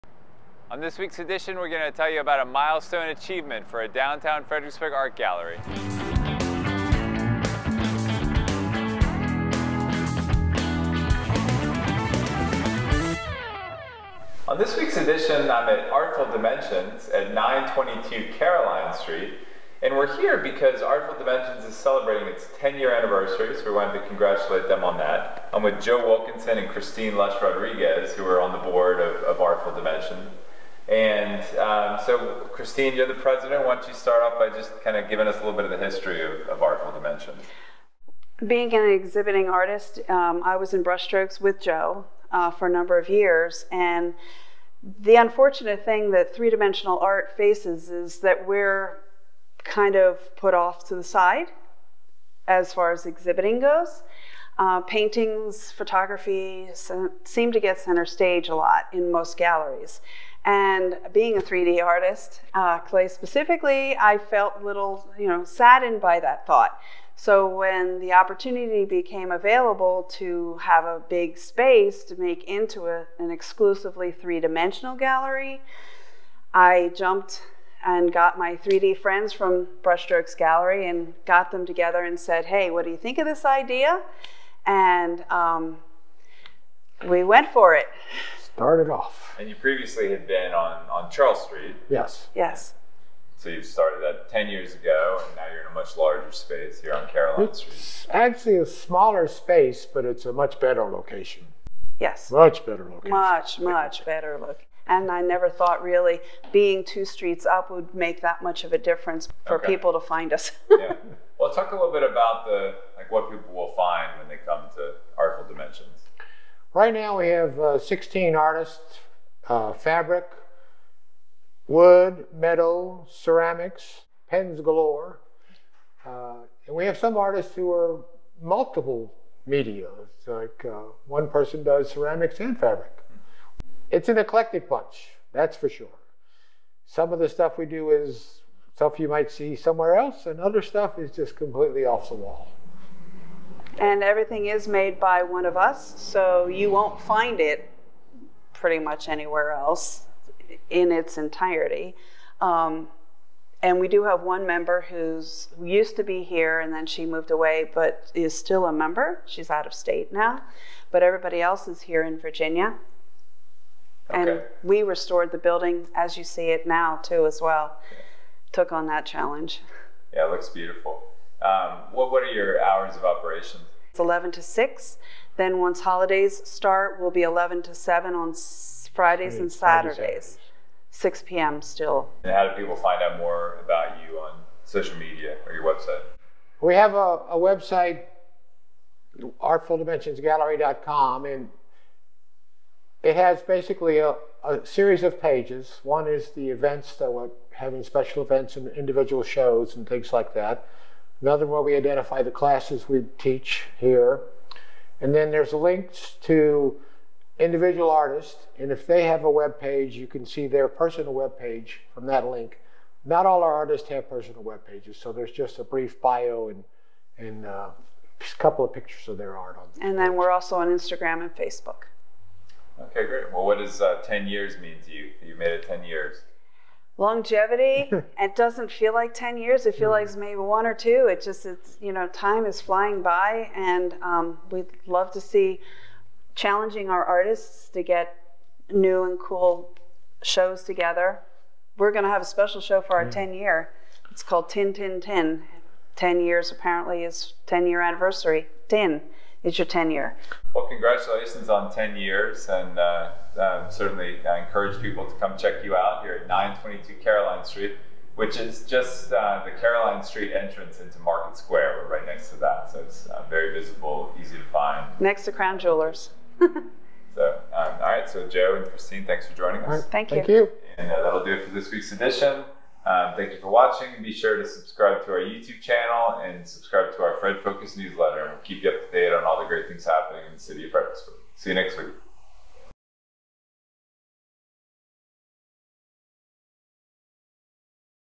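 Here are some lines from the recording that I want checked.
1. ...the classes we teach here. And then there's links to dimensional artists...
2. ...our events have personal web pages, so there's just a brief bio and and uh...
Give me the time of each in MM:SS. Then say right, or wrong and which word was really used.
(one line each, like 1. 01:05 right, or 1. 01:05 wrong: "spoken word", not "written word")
1. 03:22 wrong: "individual", not "dimensional"
2. 03:33 wrong: "artists", not "events".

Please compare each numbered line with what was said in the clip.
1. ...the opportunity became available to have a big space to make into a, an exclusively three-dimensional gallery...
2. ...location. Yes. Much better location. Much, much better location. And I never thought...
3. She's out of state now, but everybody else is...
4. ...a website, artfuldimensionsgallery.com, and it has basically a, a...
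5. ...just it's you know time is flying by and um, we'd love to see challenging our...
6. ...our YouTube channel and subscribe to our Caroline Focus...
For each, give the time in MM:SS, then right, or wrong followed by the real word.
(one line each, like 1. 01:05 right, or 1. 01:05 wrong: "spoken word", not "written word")
1. 01:07 right
2. 01:40 right
3. 02:39 right
4. 03:07 right
5. 03:51 right
6. 04:35 wrong: "Fred", not "Caroline".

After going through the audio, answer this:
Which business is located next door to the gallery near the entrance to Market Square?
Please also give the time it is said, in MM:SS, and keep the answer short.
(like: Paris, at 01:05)
Crown Jewelers, at 04:25.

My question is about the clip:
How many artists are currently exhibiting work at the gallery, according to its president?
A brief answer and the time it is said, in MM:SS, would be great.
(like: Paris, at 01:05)
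16, at 01:57.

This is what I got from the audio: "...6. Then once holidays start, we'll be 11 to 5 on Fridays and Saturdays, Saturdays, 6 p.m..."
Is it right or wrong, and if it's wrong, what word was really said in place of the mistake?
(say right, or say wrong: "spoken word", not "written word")
wrong: "7", not "5".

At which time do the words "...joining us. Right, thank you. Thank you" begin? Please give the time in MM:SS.
04:29.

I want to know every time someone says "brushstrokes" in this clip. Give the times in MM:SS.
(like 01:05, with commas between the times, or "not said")
00:40, 01:19.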